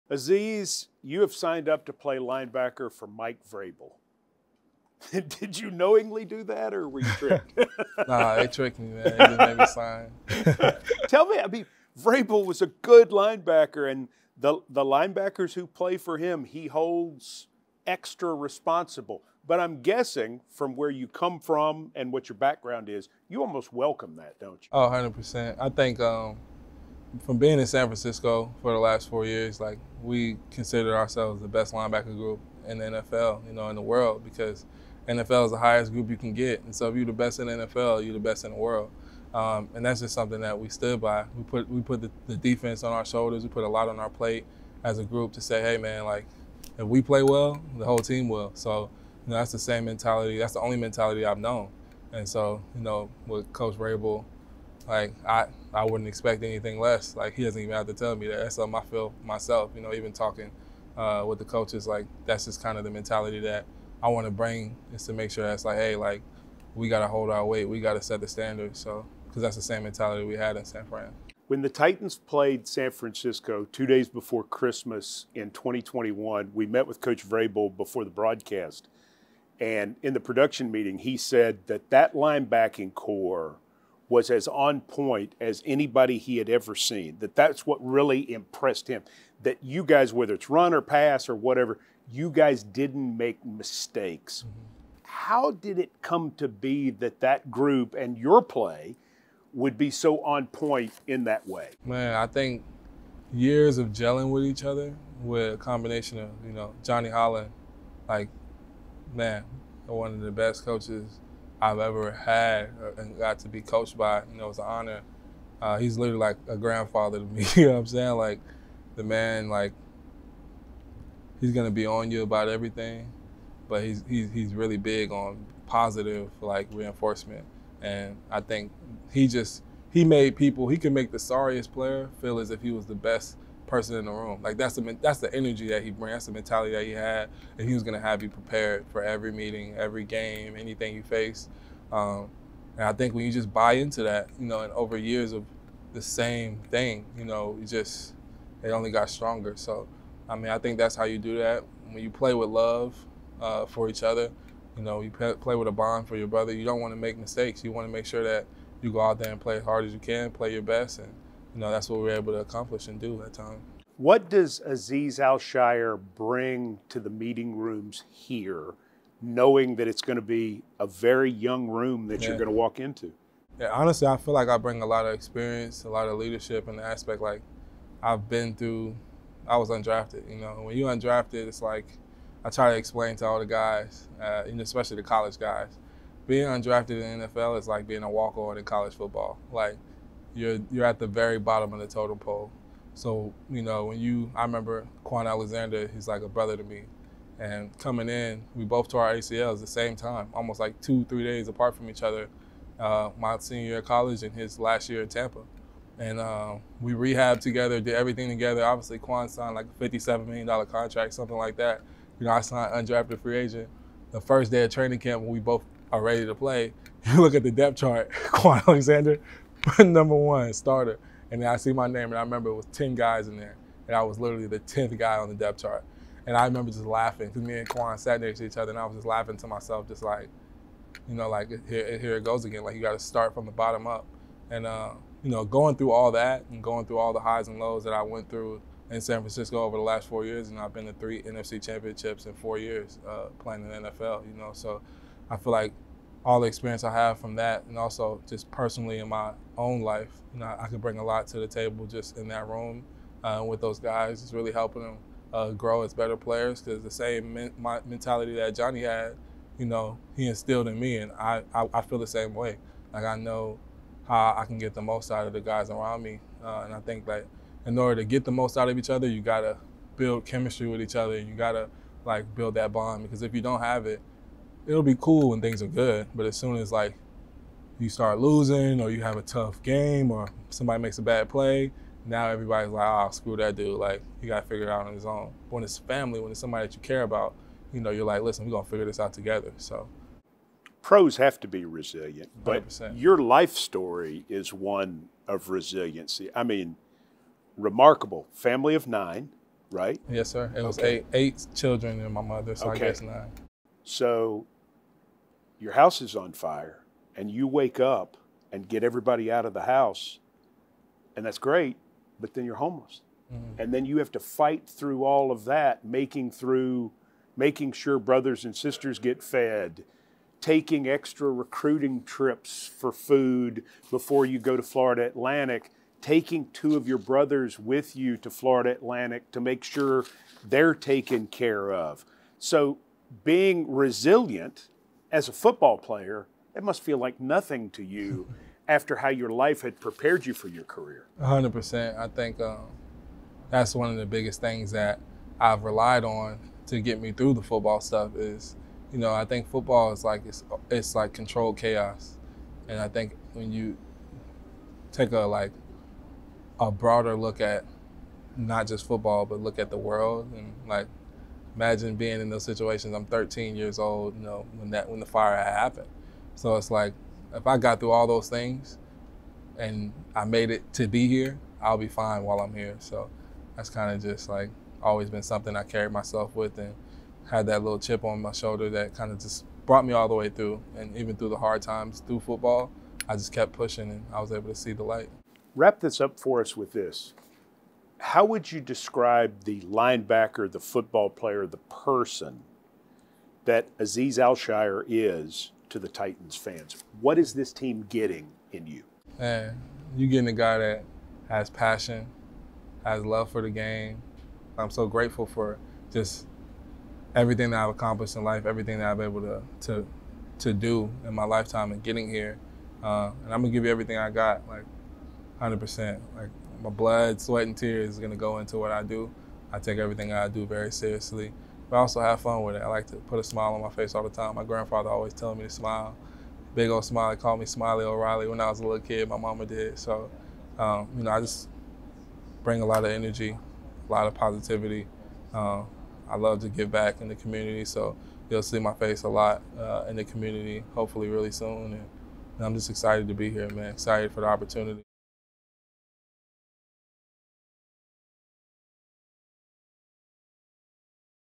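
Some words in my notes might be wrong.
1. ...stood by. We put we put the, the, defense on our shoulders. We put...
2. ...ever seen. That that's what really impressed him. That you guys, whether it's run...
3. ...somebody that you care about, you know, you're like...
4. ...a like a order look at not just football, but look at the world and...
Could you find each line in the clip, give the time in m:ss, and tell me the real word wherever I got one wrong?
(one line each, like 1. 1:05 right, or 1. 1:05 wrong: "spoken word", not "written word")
1. 0:40 right
2. 1:26 right
3. 4:46 right
4. 5:55 wrong: "broader", not "order".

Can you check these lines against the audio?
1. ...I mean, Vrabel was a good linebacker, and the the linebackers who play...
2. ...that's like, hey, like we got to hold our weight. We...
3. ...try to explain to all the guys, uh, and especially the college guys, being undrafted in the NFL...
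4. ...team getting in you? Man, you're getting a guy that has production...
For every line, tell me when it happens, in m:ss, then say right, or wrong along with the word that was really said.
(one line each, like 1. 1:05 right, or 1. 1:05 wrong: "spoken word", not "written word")
1. 0:11 right
2. 1:05 right
3. 3:02 right
4. 6:37 wrong: "passion", not "production".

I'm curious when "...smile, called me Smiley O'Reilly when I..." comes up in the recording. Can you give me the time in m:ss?
7:06.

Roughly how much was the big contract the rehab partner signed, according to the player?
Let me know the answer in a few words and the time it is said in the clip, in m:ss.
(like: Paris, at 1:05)
$57 million, at 3:29.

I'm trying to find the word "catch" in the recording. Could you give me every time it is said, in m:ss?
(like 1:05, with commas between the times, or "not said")
not said.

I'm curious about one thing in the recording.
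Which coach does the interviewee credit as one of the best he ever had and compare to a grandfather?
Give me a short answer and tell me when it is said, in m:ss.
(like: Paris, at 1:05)
Johnny Holland, at 1:46.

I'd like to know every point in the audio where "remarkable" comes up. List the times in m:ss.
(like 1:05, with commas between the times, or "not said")
4:57.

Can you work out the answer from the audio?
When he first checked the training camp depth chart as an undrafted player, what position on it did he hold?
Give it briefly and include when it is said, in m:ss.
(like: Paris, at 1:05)
10th, at 3:44.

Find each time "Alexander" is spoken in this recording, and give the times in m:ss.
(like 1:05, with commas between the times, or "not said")
3:15, 3:38.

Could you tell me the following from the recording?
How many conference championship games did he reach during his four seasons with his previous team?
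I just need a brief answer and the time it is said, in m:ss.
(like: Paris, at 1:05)
3, at 4:00.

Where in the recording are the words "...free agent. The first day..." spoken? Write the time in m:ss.
3:33.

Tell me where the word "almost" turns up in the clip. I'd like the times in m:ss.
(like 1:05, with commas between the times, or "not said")
0:23, 3:20.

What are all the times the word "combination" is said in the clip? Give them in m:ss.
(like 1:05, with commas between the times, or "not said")
1:45.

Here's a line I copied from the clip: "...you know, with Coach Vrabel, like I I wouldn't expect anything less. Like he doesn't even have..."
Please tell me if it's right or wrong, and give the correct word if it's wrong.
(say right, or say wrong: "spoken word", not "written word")
right.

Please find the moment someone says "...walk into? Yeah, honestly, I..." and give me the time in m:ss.
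2:52.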